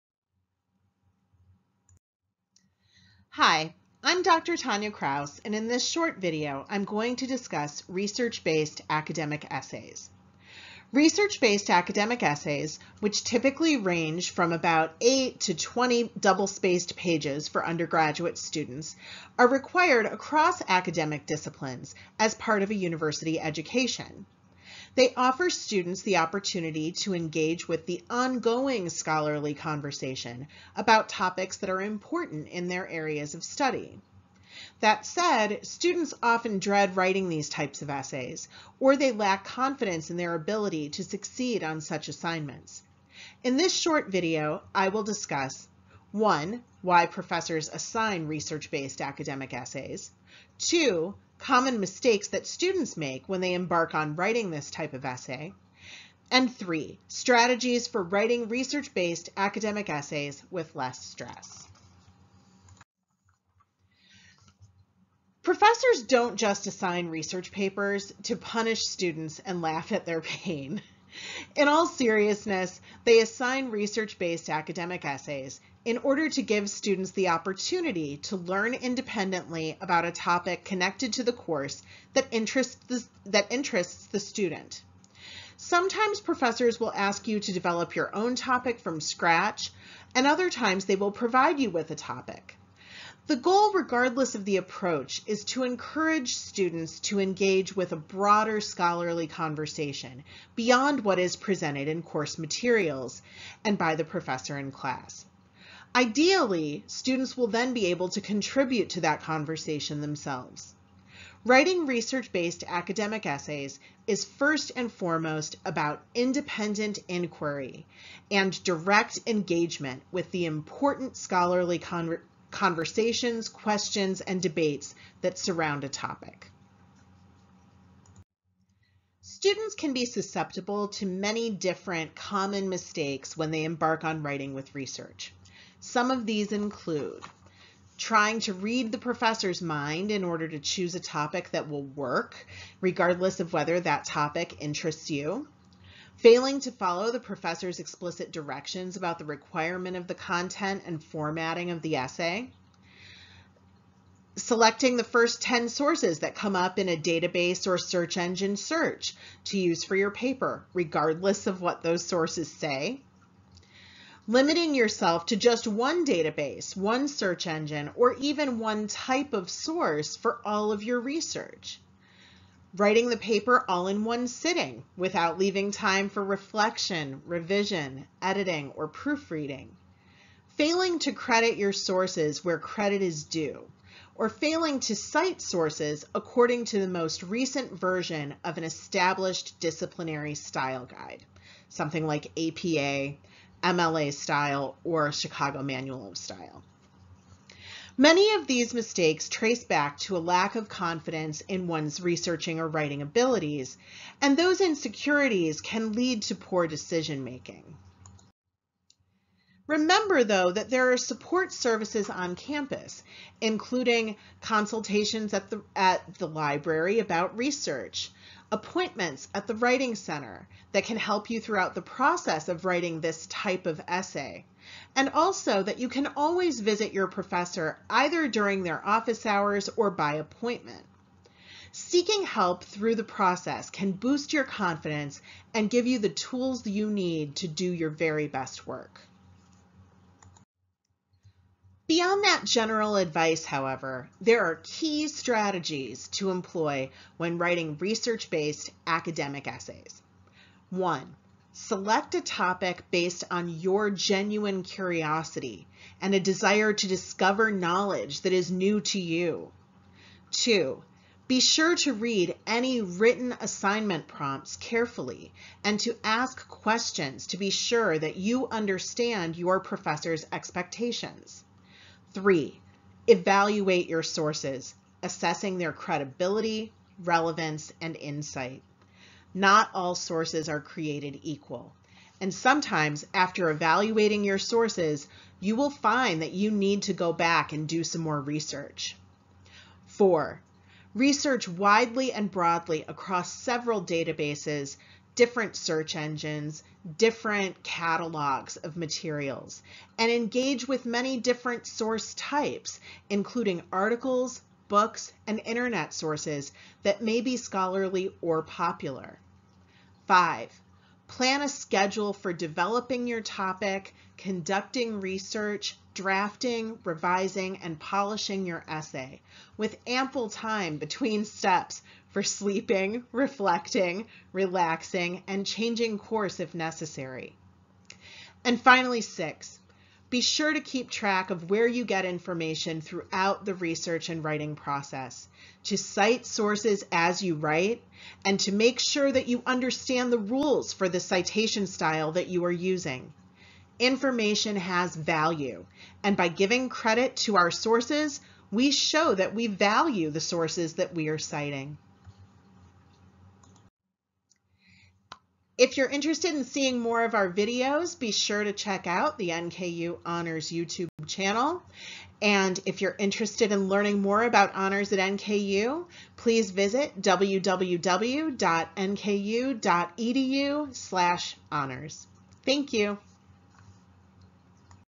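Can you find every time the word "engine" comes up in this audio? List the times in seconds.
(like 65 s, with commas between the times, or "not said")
158 s, 167 s, 295 s.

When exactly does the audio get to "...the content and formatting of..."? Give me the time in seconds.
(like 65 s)
150 s.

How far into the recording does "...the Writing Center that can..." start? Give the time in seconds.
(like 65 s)
219 s.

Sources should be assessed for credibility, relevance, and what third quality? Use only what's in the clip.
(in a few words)
insight.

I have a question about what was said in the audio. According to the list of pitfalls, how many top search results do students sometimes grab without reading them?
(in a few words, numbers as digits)
10.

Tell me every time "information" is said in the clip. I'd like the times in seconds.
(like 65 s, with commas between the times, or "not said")
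332 s, 343 s.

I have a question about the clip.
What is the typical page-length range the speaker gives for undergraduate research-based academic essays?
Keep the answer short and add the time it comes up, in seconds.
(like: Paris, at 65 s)
8 to 20 pages, at 14 s.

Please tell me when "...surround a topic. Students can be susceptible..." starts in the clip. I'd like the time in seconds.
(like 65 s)
125 s.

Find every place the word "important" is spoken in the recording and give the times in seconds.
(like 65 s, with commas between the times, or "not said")
31 s, 120 s.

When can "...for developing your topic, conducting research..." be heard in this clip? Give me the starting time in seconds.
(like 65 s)
312 s.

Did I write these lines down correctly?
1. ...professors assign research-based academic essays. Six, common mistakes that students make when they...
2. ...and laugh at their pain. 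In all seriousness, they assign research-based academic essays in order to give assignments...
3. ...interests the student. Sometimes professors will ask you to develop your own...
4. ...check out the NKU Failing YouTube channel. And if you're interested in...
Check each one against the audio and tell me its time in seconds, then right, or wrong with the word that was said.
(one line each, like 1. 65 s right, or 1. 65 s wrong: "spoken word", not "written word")
1. 47 s wrong: "Two", not "Six"
2. 69 s wrong: "students", not "assignments"
3. 83 s right
4. 358 s wrong: "Honors", not "Failing".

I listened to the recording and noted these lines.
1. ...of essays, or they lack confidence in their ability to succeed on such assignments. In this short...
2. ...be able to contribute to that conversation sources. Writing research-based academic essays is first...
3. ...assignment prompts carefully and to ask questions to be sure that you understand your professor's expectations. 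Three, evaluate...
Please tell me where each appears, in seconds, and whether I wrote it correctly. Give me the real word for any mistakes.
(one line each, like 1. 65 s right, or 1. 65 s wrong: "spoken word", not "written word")
1. 37 s right
2. 107 s wrong: "themselves", not "sources"
3. 263 s right.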